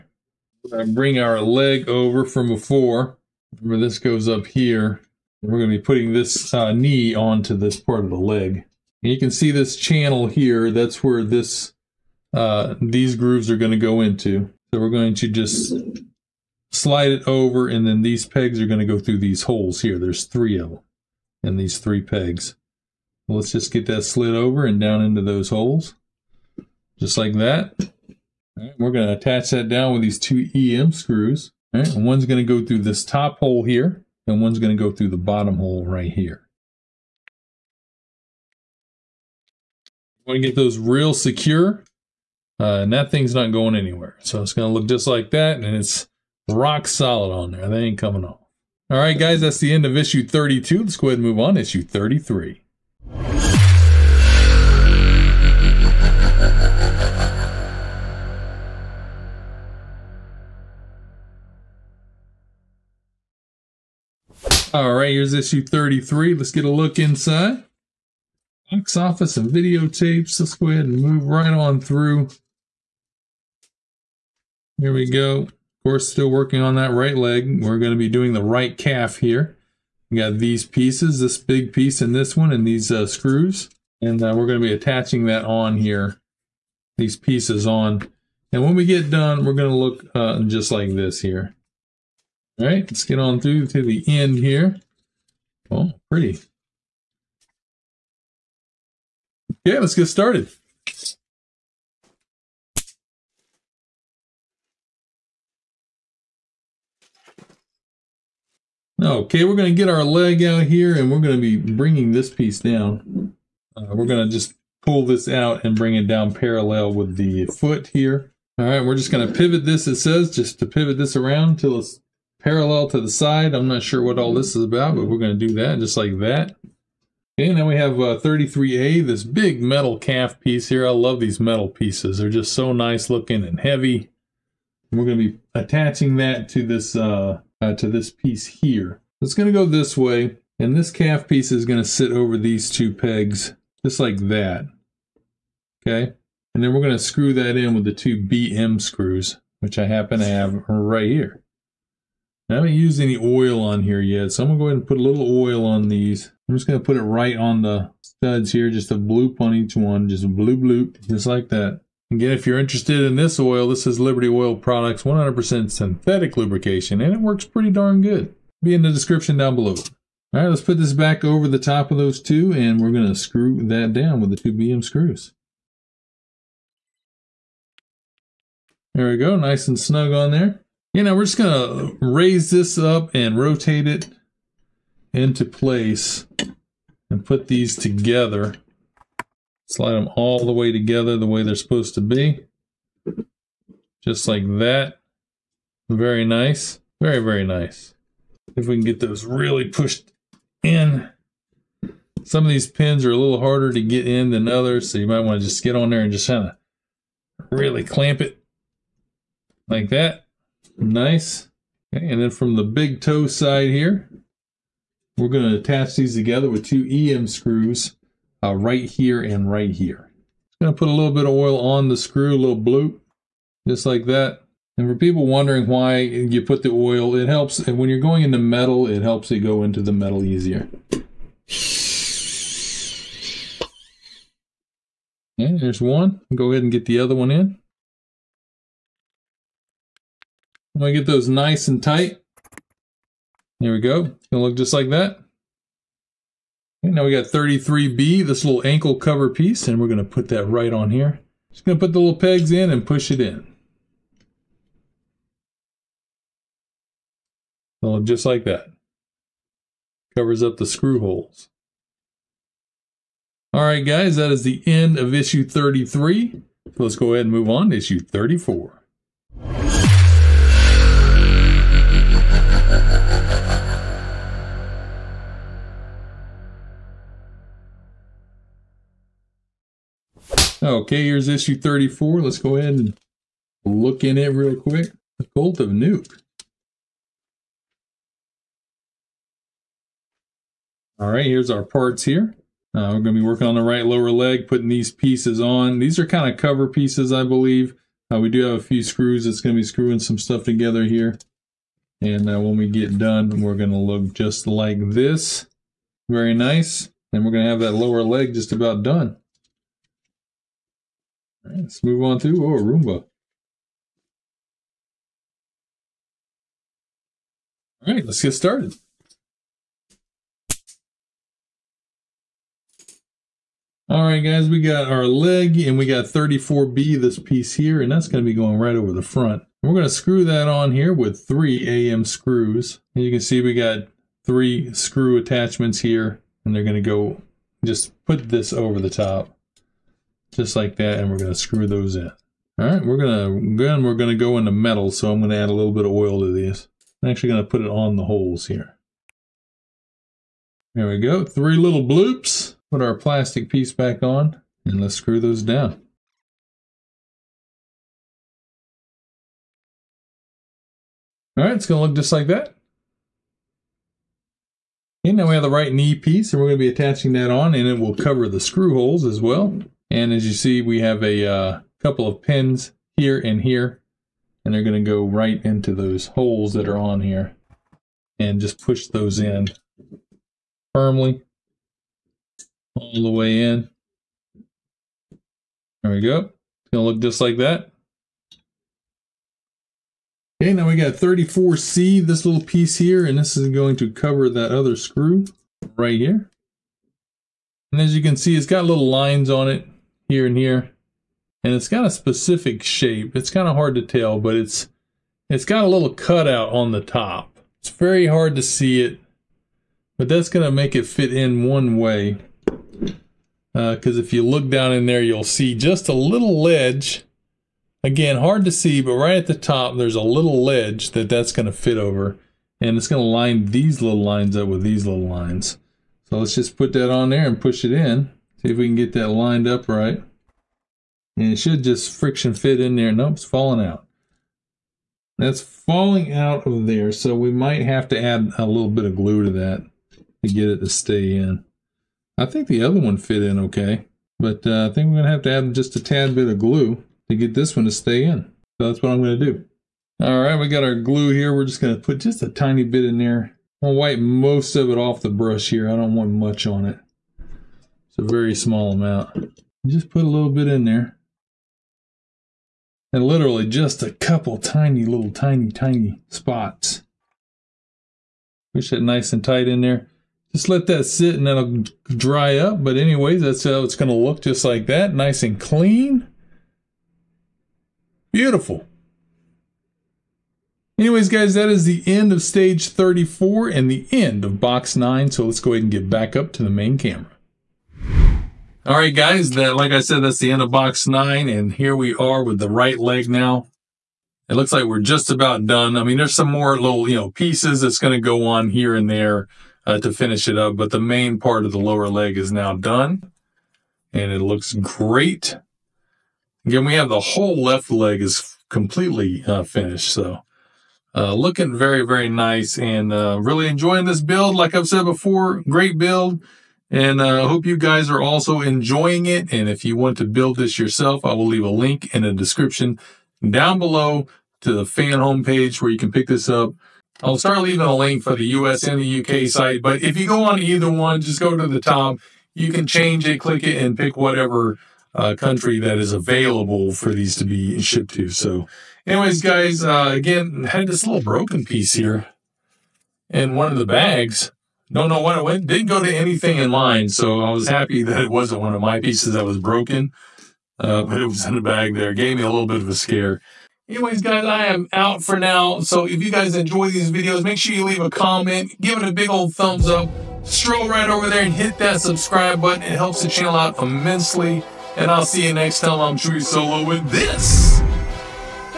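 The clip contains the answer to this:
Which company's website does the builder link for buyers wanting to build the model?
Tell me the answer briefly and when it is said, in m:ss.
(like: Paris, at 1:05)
Fanhome, at 8:44.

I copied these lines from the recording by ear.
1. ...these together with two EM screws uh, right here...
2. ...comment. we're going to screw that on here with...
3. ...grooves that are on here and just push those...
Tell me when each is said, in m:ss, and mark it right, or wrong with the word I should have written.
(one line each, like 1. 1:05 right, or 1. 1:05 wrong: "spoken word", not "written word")
1. 3:35 right
2. 5:29 wrong: "front", not "comment"
3. 6:16 wrong: "holes", not "grooves".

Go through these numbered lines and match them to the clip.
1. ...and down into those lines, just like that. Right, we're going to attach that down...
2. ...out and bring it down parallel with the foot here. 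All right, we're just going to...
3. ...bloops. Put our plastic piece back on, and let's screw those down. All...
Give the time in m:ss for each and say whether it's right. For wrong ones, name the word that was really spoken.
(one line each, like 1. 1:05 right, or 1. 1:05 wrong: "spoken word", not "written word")
1. 0:24 wrong: "holes", not "lines"
2. 1:55 right
3. 5:51 right.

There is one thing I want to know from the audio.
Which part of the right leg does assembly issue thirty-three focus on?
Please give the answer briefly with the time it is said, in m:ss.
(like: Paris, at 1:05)
Right calf, at 1:18.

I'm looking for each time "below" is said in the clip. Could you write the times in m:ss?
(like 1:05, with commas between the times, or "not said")
2:49, 8:43.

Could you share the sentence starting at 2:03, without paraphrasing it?
I'm not sure what all this is about, but we're going to do that just like that.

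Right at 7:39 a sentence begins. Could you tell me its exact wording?
just put a little bit in there.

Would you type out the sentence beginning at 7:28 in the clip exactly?
So that's what I'm going to do.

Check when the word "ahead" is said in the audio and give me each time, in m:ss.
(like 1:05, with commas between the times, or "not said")
0:51, 1:10, 2:34, 3:56, 4:27, 4:42, 8:05.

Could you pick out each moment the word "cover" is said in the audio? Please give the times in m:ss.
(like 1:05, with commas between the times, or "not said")
4:08, 4:20, 4:56, 6:07, 6:33.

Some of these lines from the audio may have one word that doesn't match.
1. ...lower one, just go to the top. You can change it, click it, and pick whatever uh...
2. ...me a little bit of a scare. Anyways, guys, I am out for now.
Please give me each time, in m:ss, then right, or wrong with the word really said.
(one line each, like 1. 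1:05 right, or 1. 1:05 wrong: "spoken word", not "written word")
1. 8:50 wrong: "either", not "lower"
2. 9:12 right.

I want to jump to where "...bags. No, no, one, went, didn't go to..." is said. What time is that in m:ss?
9:03.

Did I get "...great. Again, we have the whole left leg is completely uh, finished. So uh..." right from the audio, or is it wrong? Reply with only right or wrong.
right.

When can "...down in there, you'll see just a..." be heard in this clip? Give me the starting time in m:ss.
6:54.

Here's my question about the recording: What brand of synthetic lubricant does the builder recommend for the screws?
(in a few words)
Liberty Oil Products.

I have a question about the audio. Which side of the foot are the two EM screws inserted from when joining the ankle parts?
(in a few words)
Big toe side.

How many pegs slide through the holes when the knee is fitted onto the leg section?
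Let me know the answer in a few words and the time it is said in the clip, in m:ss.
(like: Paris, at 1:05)
3, at 0:19.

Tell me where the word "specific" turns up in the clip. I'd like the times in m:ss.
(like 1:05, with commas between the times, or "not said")
6:41.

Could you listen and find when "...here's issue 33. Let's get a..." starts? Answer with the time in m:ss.
1:05.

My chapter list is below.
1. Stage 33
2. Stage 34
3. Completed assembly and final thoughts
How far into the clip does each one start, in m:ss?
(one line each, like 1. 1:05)
1. 0:48
2. 4:22
3. 7:56.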